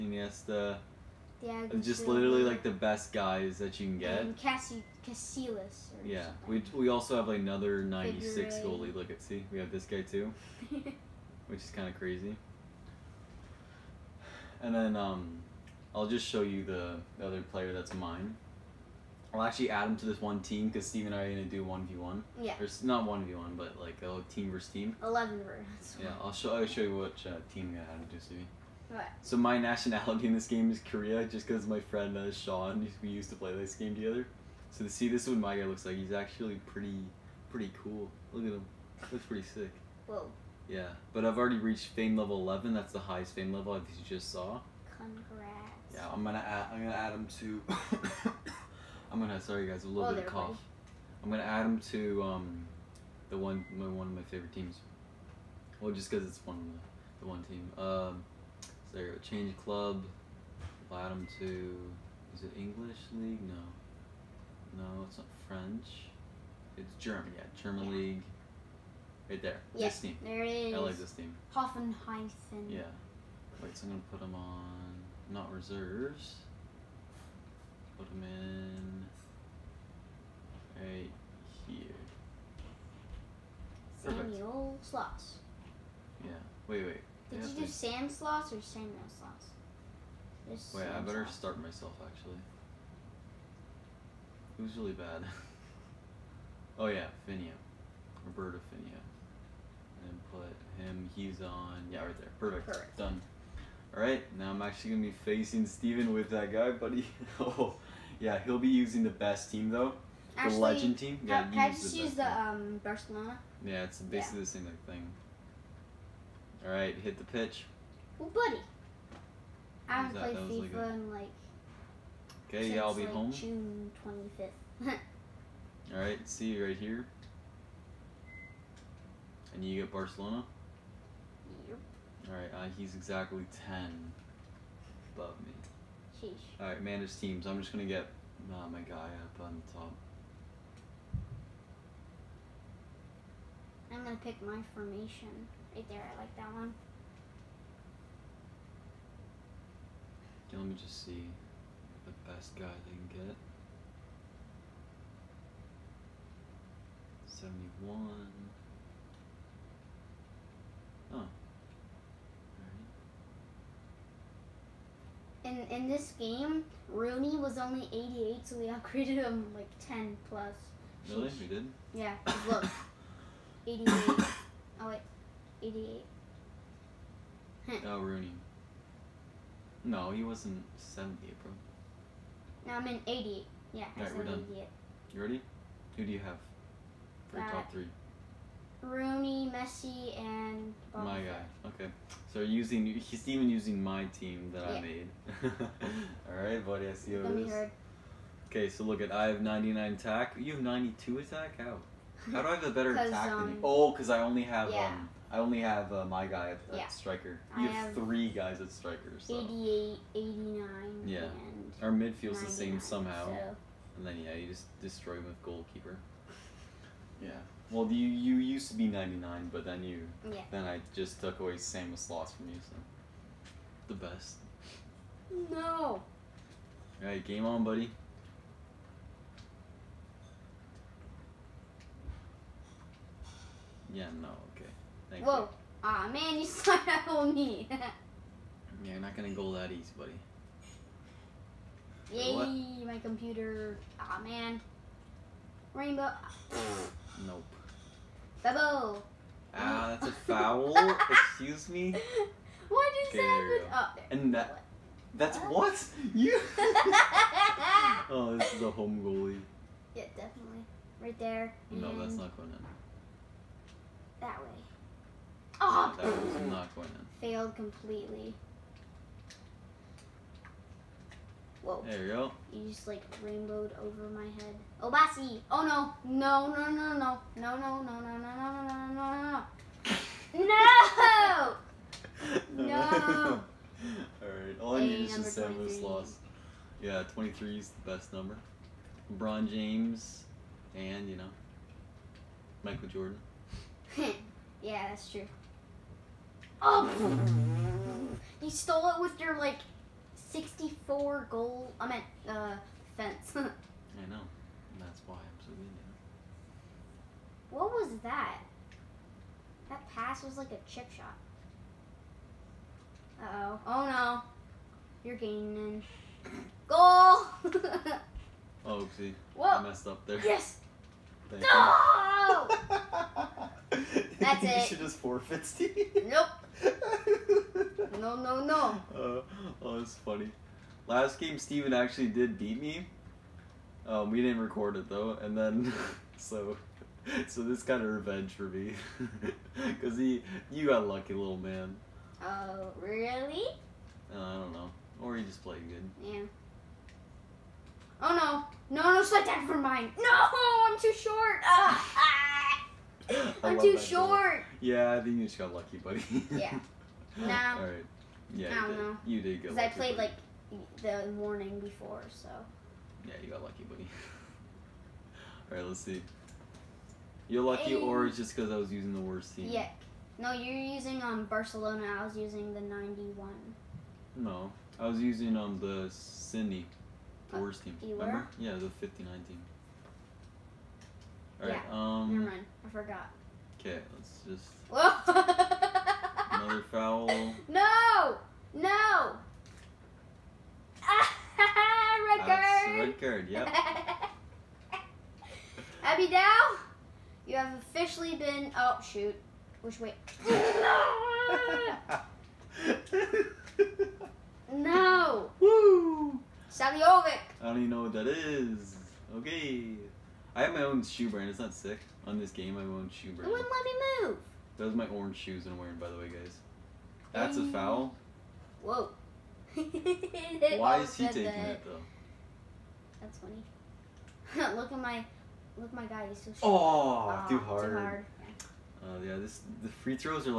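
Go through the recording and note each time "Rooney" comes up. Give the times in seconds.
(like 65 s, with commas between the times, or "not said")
166 s, 178 s, 188 s.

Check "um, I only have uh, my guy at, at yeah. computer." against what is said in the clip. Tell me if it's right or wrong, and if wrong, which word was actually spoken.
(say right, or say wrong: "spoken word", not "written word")
wrong: "striker", not "computer".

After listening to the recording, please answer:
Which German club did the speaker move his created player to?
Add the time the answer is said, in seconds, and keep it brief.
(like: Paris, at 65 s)
Hoffenheim, at 71 s.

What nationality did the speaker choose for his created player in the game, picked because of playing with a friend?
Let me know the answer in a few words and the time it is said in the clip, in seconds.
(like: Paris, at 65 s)
Korea, at 30 s.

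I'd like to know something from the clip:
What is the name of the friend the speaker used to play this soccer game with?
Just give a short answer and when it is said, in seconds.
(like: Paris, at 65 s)
Sean, at 32 s.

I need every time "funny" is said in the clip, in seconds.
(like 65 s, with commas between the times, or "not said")
329 s, 423 s.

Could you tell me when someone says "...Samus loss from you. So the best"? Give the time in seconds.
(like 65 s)
221 s.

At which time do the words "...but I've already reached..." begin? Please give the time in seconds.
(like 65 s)
41 s.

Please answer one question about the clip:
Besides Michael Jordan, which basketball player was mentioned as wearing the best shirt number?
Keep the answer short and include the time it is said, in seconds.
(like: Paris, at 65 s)
LeBron James, at 289 s.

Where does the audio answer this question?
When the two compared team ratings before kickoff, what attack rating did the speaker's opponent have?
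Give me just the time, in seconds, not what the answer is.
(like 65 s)
200 s.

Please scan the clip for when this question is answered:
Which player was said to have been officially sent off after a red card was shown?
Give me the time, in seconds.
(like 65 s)
395 s.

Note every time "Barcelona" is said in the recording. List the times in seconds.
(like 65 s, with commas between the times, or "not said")
112 s, 129 s, 371 s.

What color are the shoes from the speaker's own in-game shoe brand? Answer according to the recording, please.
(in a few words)
Orange.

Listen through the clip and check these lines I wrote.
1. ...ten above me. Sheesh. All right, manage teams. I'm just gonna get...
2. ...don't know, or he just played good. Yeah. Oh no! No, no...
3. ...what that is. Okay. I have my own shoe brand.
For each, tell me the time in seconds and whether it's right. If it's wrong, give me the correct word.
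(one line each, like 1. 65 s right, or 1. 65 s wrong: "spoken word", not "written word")
1. 133 s right
2. 344 s right
3. 407 s right.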